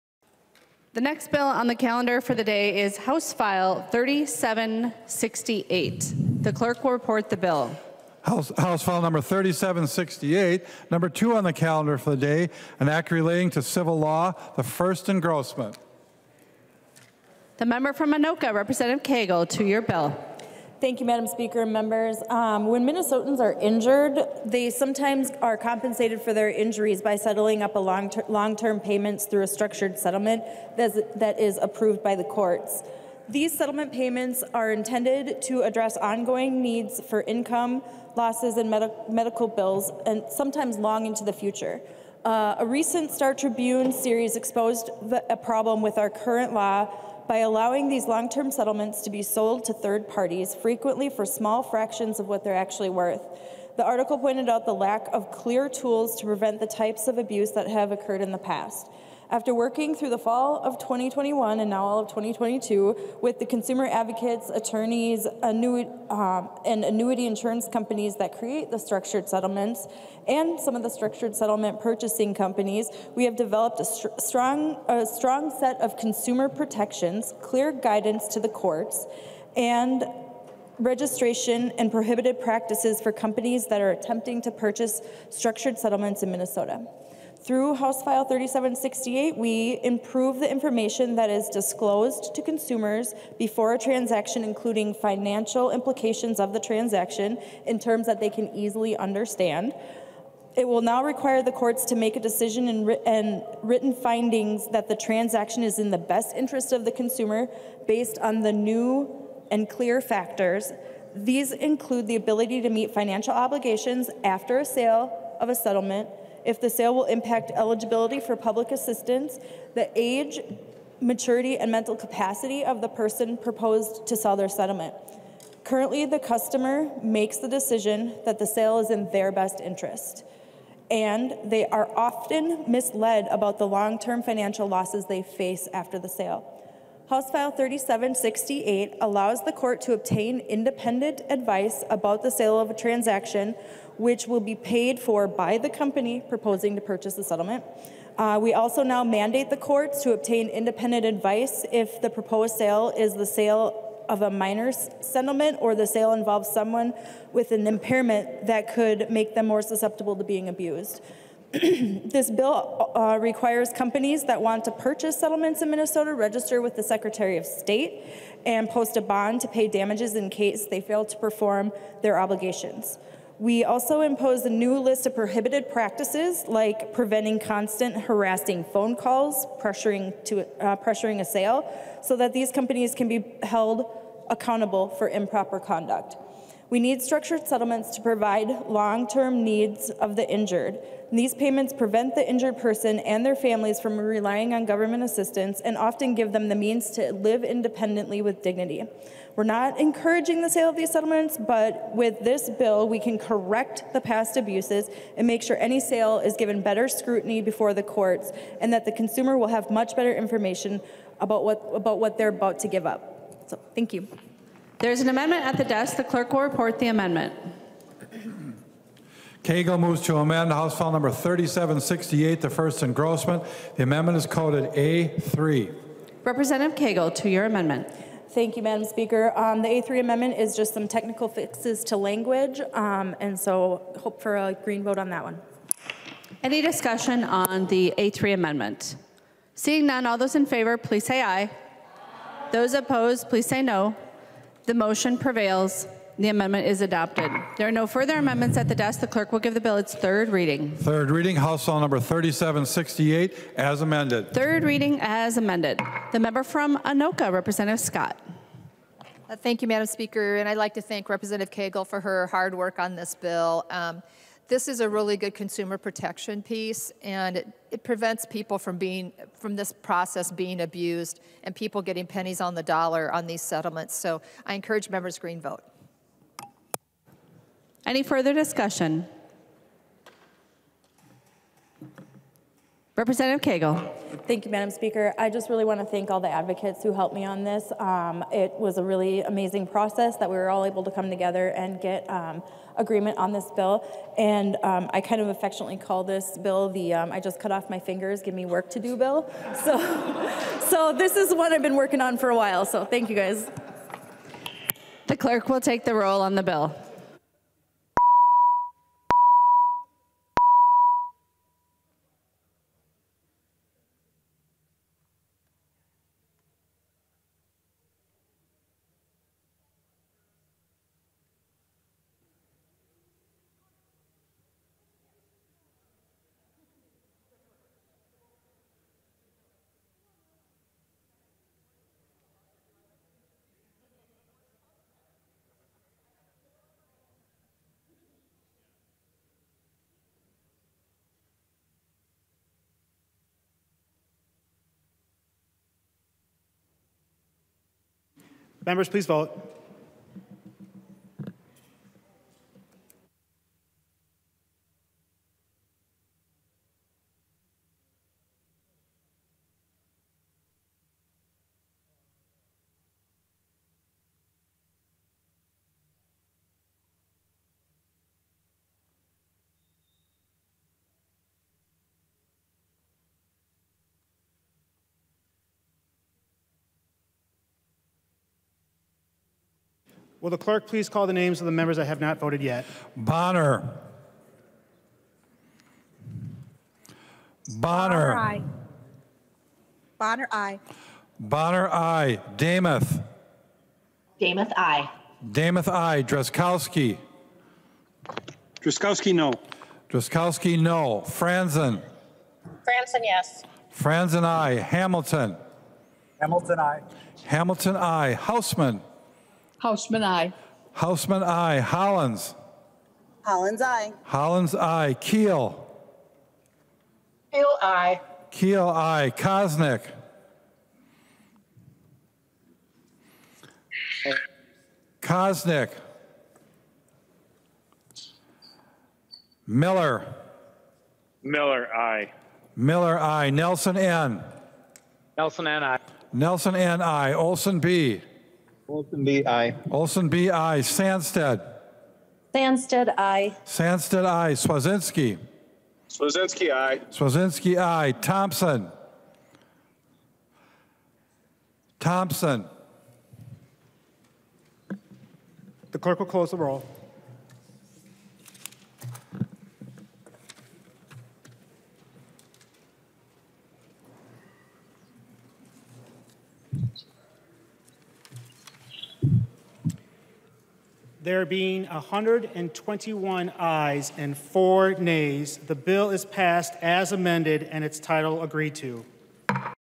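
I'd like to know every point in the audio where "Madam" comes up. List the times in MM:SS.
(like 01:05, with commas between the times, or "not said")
00:21, 03:48, 04:19, 04:44.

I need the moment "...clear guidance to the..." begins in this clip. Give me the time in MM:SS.
01:17.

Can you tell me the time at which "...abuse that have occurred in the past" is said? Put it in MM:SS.
00:57.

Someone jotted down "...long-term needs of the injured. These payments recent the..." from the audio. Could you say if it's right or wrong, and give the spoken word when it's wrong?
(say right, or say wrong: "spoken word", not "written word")
wrong: "prevent", not "recent".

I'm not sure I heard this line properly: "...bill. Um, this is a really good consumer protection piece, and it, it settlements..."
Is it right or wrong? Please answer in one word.
wrong.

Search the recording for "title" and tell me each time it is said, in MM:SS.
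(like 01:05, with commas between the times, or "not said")
07:57.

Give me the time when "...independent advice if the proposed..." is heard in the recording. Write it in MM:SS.
02:30.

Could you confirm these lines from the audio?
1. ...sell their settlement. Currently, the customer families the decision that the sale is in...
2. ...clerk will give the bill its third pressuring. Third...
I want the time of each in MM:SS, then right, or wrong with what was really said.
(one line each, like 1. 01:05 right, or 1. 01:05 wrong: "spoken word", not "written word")
1. 02:04 wrong: "makes", not "families"
2. 04:09 wrong: "reading", not "pressuring".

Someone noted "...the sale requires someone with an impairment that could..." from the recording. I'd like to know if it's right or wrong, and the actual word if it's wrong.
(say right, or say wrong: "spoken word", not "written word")
wrong: "involves", not "requires".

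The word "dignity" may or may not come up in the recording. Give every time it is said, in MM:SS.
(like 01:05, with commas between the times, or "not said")
03:18.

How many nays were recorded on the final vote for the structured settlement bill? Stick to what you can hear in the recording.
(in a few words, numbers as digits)
4.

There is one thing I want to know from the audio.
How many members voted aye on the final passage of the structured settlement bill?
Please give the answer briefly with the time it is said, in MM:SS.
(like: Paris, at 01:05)
121, at 07:51.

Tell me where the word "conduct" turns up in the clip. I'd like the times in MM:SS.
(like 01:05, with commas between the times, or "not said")
03:05.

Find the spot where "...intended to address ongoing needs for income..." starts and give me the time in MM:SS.
00:34.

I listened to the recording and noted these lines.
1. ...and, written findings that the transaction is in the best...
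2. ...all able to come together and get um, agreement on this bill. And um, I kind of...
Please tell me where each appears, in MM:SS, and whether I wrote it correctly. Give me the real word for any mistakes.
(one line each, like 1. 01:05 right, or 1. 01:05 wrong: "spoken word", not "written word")
1. 01:42 right
2. 04:50 right.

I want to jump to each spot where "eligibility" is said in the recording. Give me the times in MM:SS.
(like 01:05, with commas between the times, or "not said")
01:57.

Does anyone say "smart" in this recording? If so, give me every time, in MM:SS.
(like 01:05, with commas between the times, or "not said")
not said.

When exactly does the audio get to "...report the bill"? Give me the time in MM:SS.
00:06.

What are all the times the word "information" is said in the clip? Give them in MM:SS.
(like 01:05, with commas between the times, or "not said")
01:30, 03:30.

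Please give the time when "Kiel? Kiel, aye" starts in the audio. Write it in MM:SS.
06:54.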